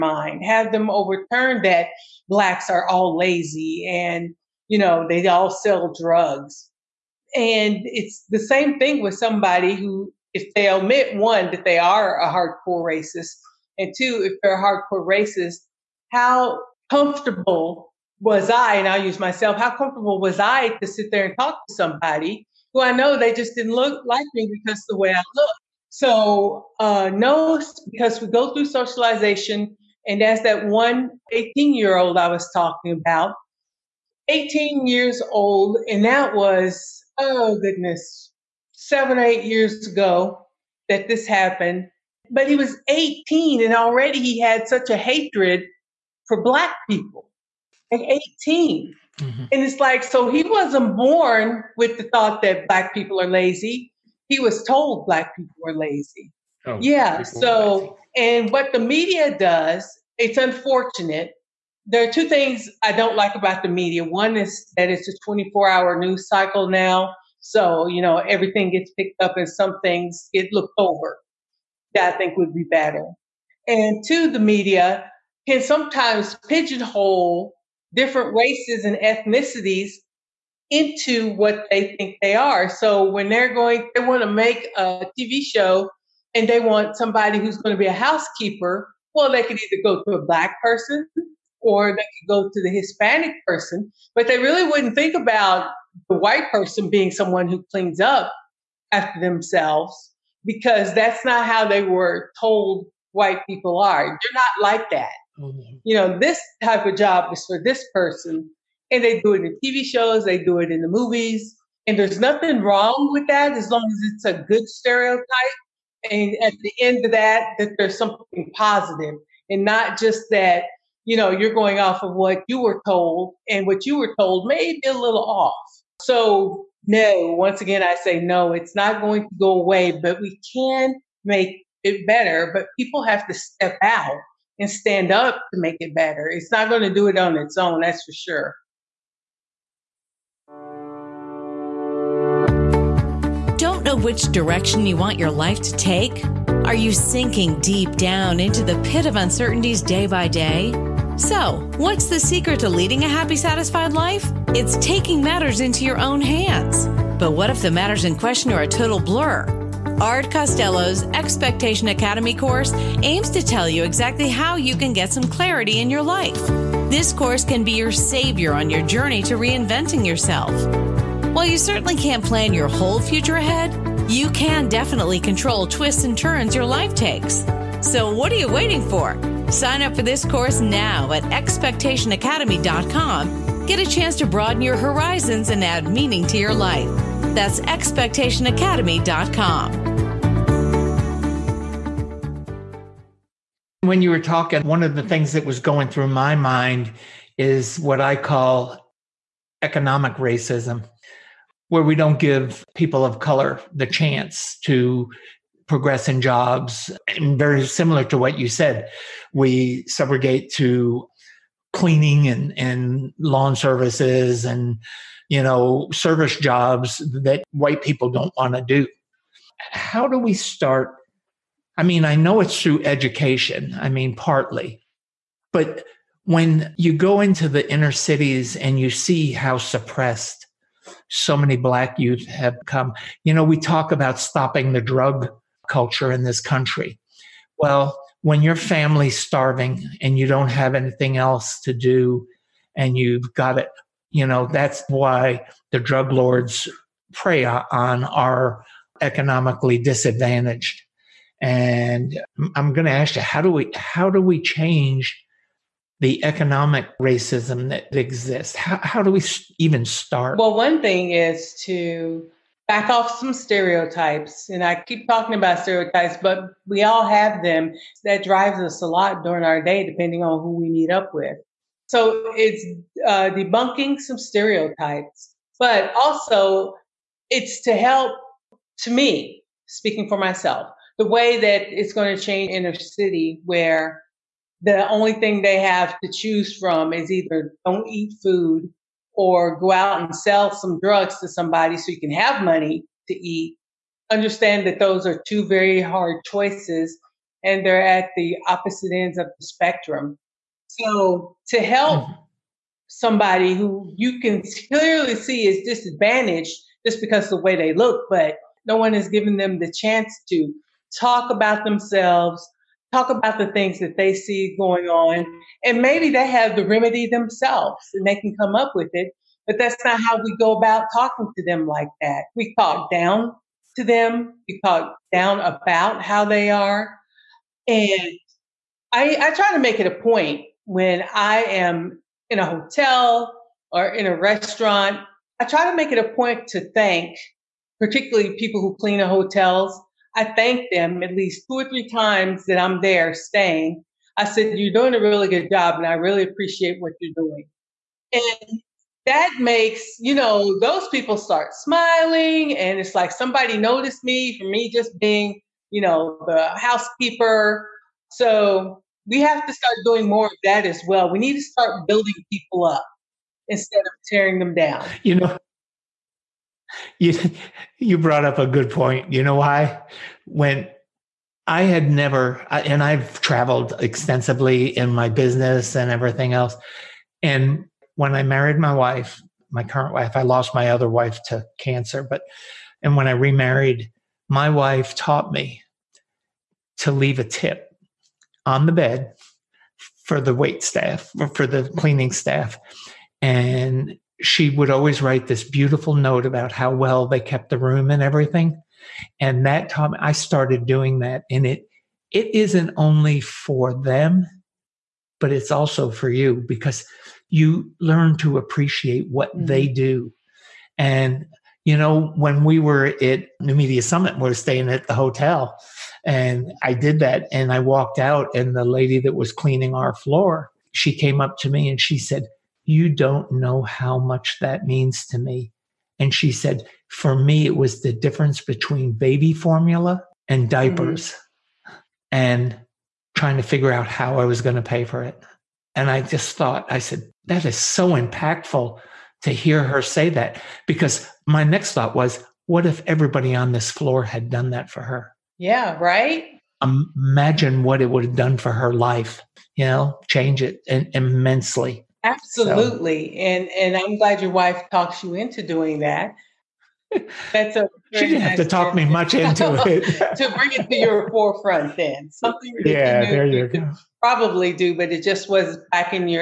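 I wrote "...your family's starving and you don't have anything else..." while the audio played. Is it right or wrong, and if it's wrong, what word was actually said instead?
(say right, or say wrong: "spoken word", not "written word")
right.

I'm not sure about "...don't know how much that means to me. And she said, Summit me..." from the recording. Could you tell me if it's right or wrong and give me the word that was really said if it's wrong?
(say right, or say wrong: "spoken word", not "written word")
wrong: "For", not "Summit".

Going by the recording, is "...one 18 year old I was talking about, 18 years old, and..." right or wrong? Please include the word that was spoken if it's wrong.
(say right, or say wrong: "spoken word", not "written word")
right.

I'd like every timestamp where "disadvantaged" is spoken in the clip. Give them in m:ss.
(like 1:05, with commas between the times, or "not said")
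4:09, 5:05.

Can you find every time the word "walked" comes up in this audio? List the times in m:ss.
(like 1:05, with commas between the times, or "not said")
6:57.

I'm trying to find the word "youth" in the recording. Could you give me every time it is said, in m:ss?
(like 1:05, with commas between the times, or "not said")
3:51.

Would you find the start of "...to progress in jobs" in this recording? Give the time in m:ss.
3:24.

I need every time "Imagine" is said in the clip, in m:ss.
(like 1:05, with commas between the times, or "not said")
7:26.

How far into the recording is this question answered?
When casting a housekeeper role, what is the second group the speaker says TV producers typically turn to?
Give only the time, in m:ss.
1:32.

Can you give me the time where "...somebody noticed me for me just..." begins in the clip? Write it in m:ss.
5:53.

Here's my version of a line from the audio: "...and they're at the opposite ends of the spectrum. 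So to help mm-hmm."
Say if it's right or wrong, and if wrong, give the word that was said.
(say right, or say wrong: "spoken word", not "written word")
right.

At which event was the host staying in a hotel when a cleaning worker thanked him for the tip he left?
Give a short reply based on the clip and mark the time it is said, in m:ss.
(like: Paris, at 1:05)
New Media Summit, at 6:53.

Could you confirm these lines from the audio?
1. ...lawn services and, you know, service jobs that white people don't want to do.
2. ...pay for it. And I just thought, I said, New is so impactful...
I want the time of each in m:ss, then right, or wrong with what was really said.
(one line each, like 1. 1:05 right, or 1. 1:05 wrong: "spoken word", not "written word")
1. 3:33 right
2. 7:14 wrong: "That", not "New".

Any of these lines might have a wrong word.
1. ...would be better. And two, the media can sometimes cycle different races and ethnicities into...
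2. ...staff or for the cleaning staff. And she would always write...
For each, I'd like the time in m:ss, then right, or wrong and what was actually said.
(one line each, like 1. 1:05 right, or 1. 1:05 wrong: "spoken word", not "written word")
1. 1:12 wrong: "pigeonhole", not "cycle"
2. 6:30 right.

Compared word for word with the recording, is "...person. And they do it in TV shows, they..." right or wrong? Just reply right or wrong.
right.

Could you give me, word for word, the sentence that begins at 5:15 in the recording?
And maybe they have the remedy themselves and they can come up with it.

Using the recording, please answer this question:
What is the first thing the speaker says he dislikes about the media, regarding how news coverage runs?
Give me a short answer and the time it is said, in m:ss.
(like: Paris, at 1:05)
24 hour news cycle, at 1:05.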